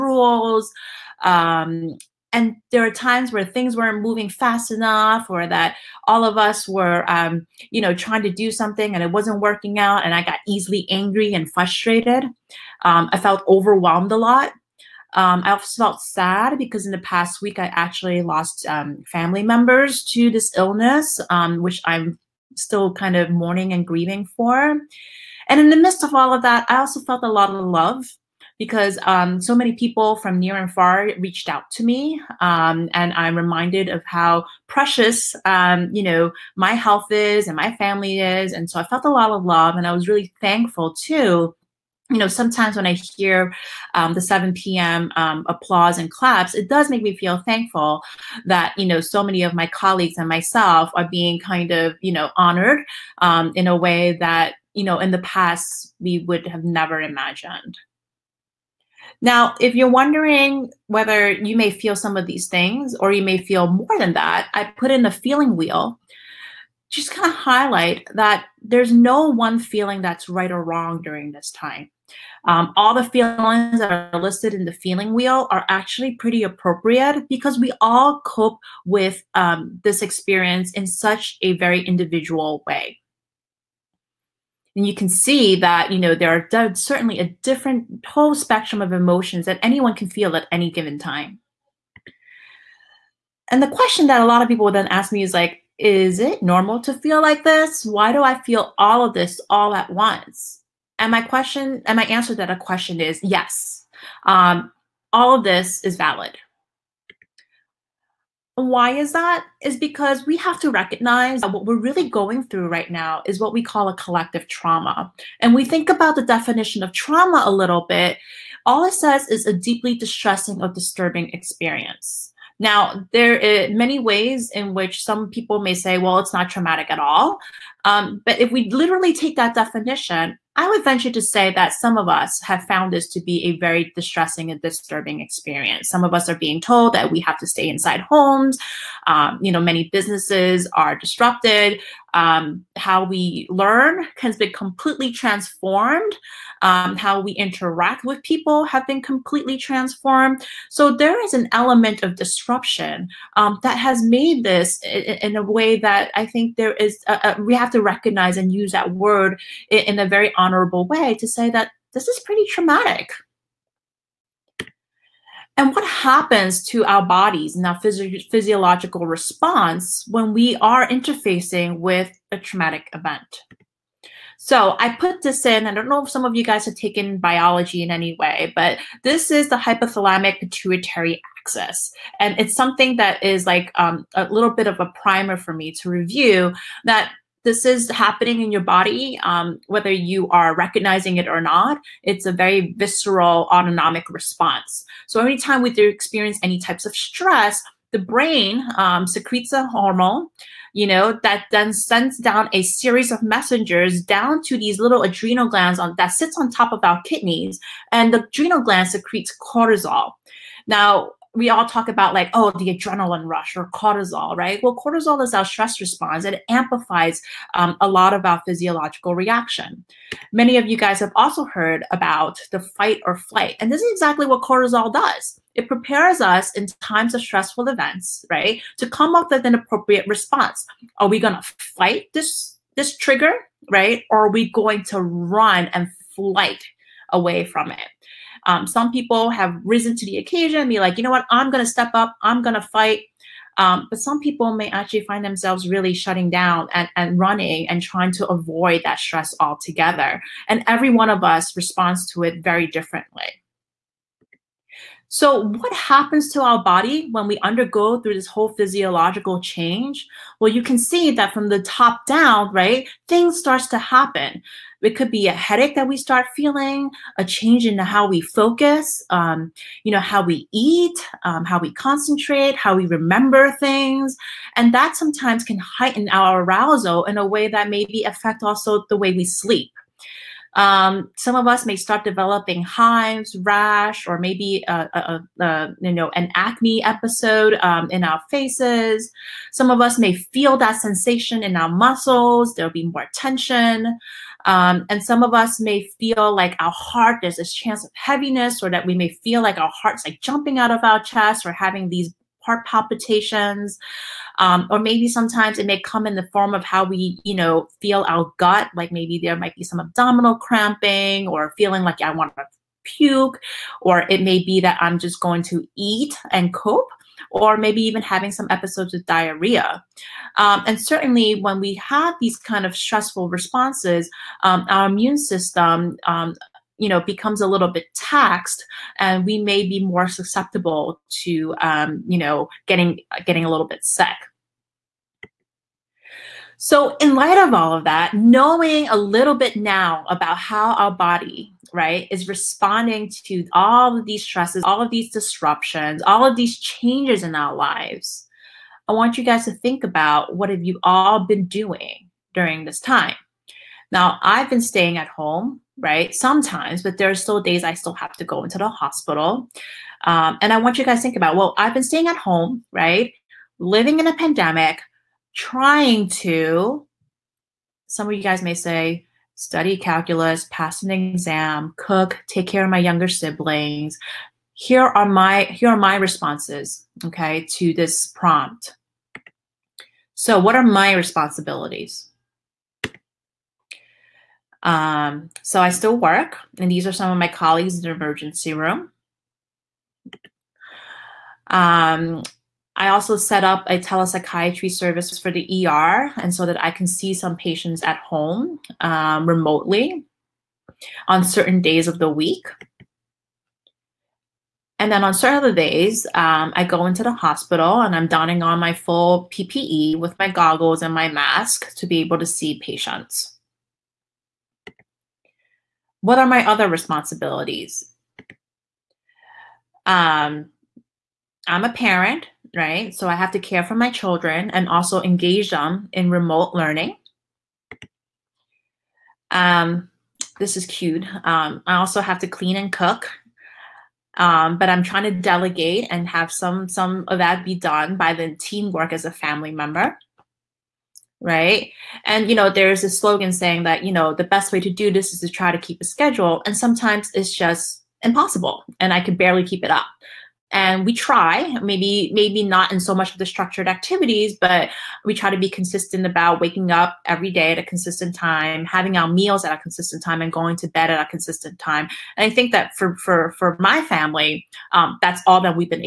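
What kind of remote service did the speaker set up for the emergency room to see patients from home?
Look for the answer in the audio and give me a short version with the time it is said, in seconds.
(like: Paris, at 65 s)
telepsychiatry service, at 393 s.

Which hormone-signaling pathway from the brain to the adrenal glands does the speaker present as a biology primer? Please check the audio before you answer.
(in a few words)
hypothalamic pituitary axis.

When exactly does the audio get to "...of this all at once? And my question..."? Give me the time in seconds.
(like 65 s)
99 s.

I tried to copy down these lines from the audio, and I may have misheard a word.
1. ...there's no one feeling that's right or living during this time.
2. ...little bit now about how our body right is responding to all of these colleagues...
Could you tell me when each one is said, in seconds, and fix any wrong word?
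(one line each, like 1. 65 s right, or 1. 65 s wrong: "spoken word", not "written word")
1. 68 s wrong: "wrong", not "living"
2. 338 s wrong: "stresses", not "colleagues".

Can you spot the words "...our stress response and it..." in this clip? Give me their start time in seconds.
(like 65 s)
215 s.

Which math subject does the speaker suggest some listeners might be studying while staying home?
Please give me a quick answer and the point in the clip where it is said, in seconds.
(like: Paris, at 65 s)
calculus, at 369 s.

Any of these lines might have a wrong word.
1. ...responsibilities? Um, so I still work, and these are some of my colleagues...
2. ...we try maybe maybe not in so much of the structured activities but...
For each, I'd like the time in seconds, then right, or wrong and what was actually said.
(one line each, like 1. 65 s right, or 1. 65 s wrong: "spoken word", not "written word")
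1. 380 s right
2. 450 s right.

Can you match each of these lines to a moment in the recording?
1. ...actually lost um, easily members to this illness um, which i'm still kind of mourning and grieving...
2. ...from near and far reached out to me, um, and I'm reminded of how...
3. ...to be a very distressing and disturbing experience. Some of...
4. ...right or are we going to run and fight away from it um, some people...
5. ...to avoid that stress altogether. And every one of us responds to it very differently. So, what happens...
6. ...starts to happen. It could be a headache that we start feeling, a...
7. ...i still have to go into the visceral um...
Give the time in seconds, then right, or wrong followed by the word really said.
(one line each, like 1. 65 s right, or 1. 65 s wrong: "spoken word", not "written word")
1. 17 s wrong: "family", not "easily"
2. 30 s right
3. 133 s right
4. 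233 s wrong: "flight", not "fight"
5. 248 s right
6. 263 s right
7. 357 s wrong: "hospital", not "visceral".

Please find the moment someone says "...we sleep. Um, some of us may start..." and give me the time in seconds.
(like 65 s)
279 s.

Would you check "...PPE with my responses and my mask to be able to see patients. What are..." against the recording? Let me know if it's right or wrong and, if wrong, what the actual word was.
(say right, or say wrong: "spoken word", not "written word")
wrong: "goggles", not "responses".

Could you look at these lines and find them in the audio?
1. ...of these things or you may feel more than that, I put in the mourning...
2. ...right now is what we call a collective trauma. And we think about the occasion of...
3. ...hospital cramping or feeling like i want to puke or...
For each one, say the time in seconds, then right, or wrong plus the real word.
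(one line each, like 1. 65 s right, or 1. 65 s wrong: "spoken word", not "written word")
1. 62 s wrong: "feeling", not "mourning"
2. 112 s wrong: "definition", not "occasion"
3. 309 s wrong: "abdominal", not "hospital".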